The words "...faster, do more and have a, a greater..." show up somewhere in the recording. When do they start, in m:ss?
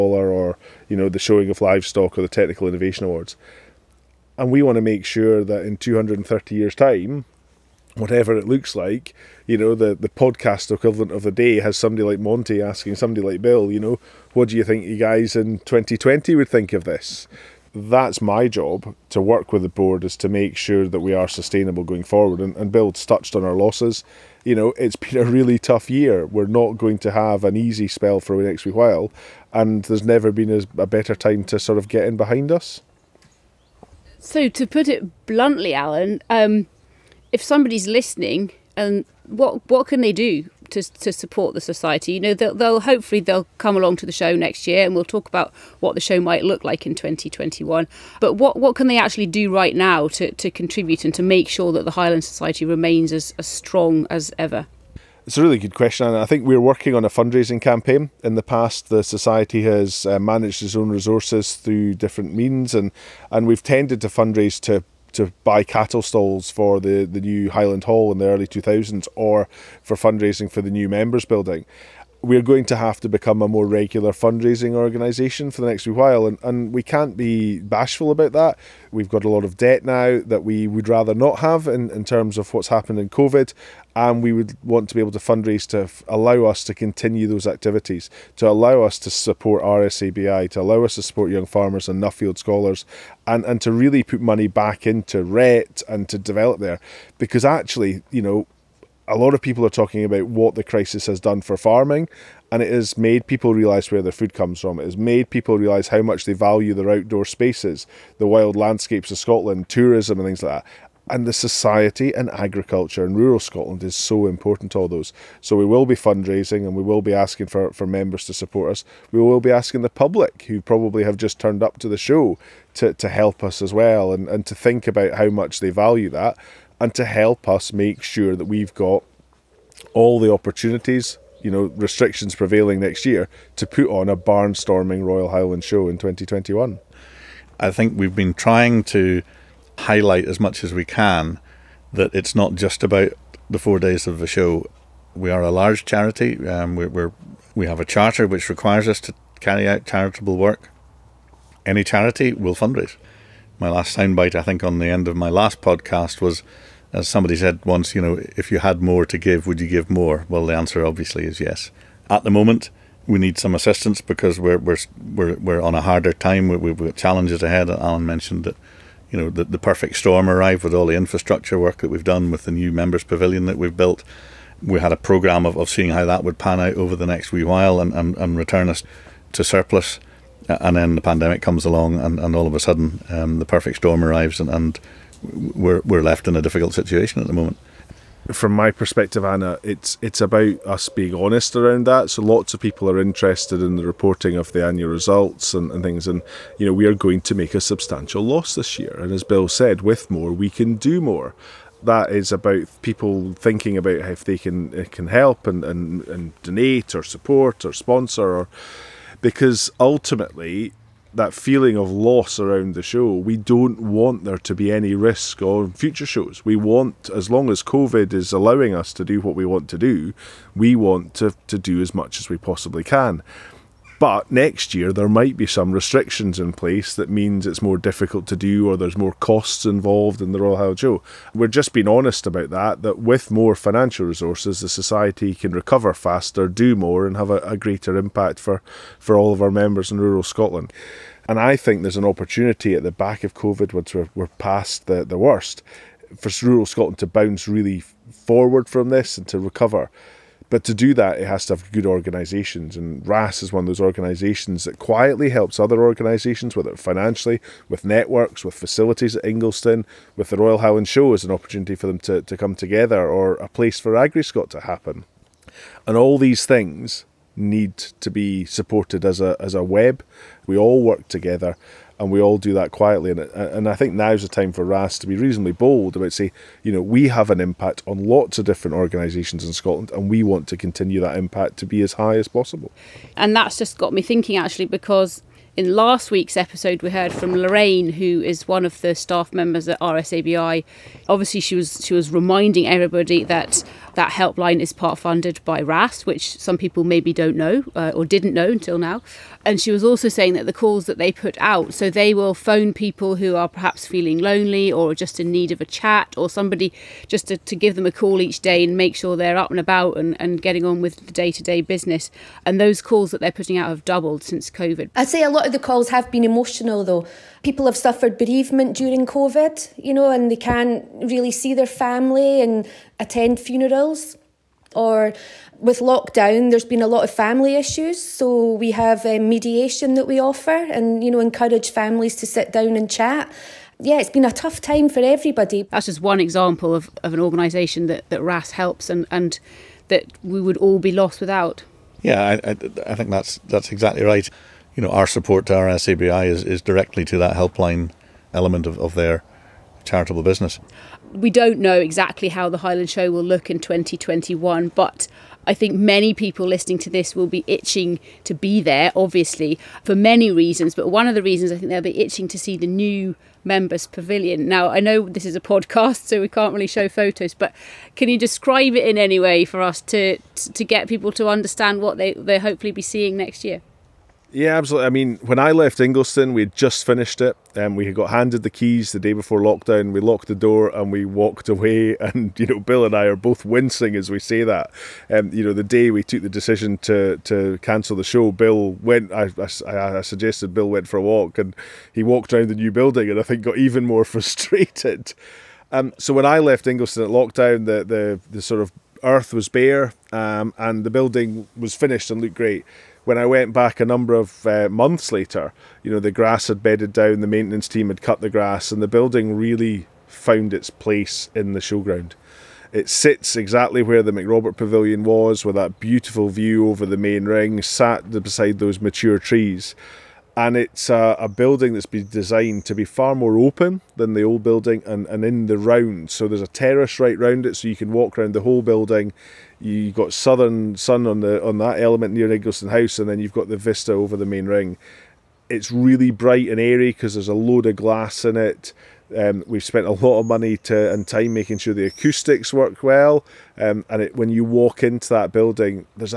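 3:55.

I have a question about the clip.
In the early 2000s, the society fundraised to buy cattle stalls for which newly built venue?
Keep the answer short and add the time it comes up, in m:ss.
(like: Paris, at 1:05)
Highland Hall, at 1:07.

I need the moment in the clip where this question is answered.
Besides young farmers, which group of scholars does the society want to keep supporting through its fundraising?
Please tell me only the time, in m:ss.
1:32.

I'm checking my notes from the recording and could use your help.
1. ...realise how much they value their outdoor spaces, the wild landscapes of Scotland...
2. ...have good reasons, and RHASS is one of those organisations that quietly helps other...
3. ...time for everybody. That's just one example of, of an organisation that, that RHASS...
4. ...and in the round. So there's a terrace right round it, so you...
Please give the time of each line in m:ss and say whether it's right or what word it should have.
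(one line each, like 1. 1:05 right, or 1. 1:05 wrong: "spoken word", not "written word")
1. 1:45 right
2. 4:11 wrong: "organisations", not "reasons"
3. 5:34 right
4. 7:05 right.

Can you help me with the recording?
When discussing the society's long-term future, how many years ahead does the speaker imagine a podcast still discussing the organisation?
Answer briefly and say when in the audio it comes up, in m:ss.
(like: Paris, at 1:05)
230 years, at 0:05.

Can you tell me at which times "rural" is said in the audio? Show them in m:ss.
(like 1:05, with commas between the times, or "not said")
1:53, 4:00, 4:06.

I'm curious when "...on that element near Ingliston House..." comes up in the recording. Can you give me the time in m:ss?
7:11.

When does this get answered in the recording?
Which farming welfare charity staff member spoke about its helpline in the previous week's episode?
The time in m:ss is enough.
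4:47.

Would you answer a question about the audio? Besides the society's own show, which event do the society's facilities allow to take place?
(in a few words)
AgriScot.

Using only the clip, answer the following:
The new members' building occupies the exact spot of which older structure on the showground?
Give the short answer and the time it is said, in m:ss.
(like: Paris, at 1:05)
McRobert Pavilion, at 6:54.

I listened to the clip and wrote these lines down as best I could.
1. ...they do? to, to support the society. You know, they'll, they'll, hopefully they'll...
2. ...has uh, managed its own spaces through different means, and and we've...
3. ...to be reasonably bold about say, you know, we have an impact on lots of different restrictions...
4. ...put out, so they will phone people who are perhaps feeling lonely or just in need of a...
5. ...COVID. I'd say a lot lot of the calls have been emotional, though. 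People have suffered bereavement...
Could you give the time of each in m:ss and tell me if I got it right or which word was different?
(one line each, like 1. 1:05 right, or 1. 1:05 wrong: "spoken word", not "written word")
1. 0:40 right
2. 0:59 wrong: "resources", not "spaces"
3. 4:35 wrong: "organisations", not "restrictions"
4. 5:01 right
5. 5:14 right.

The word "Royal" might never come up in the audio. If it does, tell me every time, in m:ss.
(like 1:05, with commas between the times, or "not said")
2:15, 3:50, 4:20.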